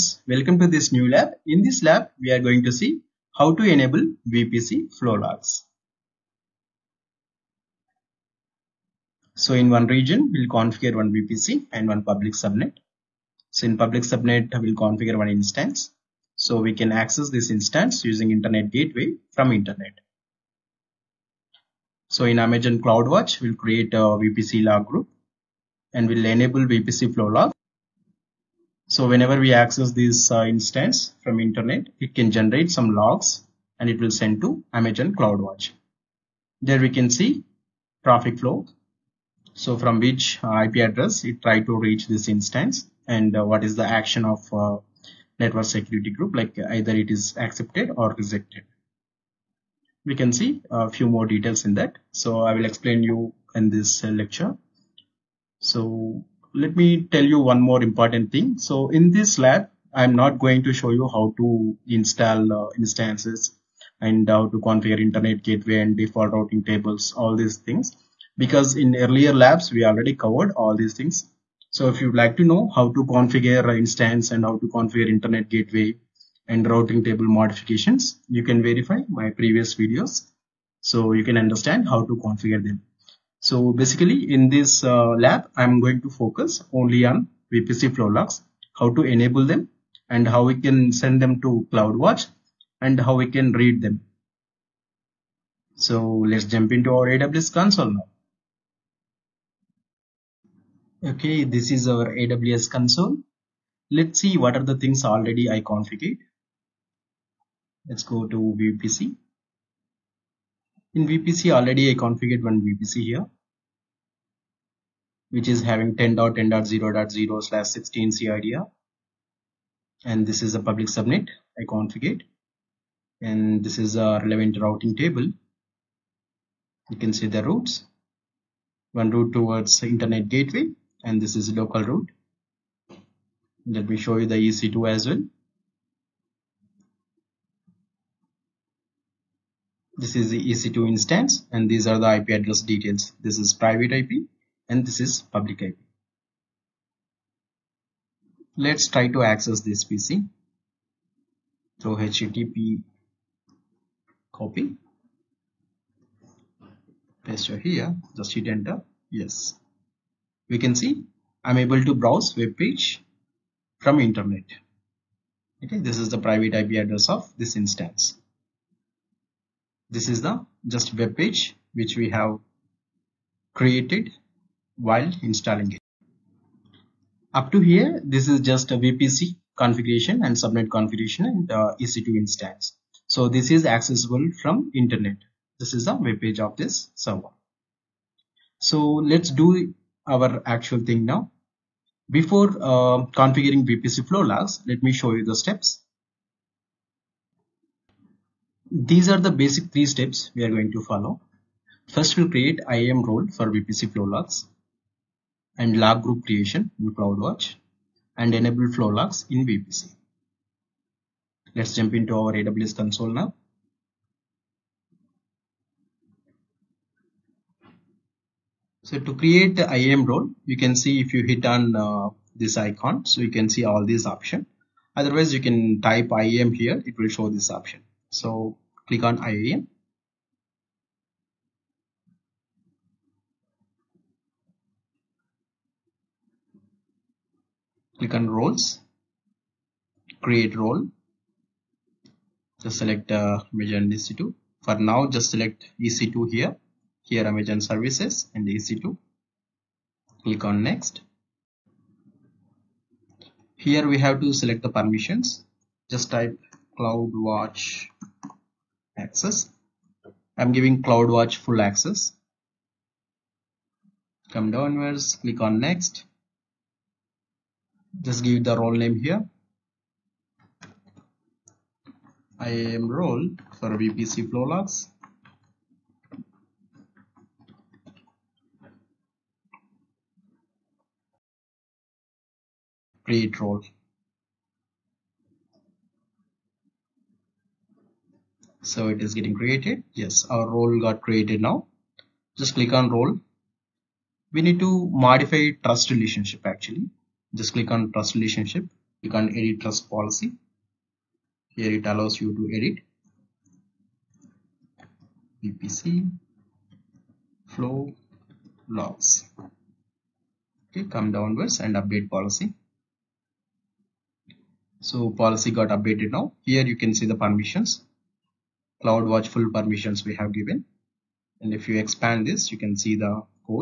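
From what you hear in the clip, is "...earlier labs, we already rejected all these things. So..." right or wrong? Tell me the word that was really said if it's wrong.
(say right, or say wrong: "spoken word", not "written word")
wrong: "covered", not "rejected".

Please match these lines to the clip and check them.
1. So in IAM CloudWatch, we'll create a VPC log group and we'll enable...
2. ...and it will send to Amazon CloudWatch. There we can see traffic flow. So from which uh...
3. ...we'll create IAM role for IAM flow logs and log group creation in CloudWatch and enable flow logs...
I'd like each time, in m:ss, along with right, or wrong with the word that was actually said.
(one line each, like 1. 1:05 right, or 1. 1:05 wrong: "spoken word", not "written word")
1. 0:22 wrong: "Amazon", not "IAM"
2. 0:33 right
3. 3:22 wrong: "VPC", not "IAM".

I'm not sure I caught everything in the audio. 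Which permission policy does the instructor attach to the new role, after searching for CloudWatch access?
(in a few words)
CloudWatch full access.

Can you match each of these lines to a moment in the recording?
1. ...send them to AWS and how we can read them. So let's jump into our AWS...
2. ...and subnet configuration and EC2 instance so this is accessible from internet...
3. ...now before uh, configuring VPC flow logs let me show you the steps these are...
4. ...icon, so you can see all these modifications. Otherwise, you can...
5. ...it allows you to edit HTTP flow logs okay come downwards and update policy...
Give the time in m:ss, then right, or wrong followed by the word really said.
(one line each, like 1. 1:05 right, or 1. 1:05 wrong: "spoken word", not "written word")
1. 1:30 wrong: "CloudWatch", not "AWS"
2. 3:00 right
3. 3:11 right
4. 3:42 wrong: "options", not "modifications"
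5. 5:01 wrong: "VPC", not "HTTP".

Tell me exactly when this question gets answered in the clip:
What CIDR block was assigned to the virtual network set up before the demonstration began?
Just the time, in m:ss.
1:55.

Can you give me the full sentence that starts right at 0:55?
So let me tell you one more important thing.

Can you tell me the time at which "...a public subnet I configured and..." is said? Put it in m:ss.
2:00.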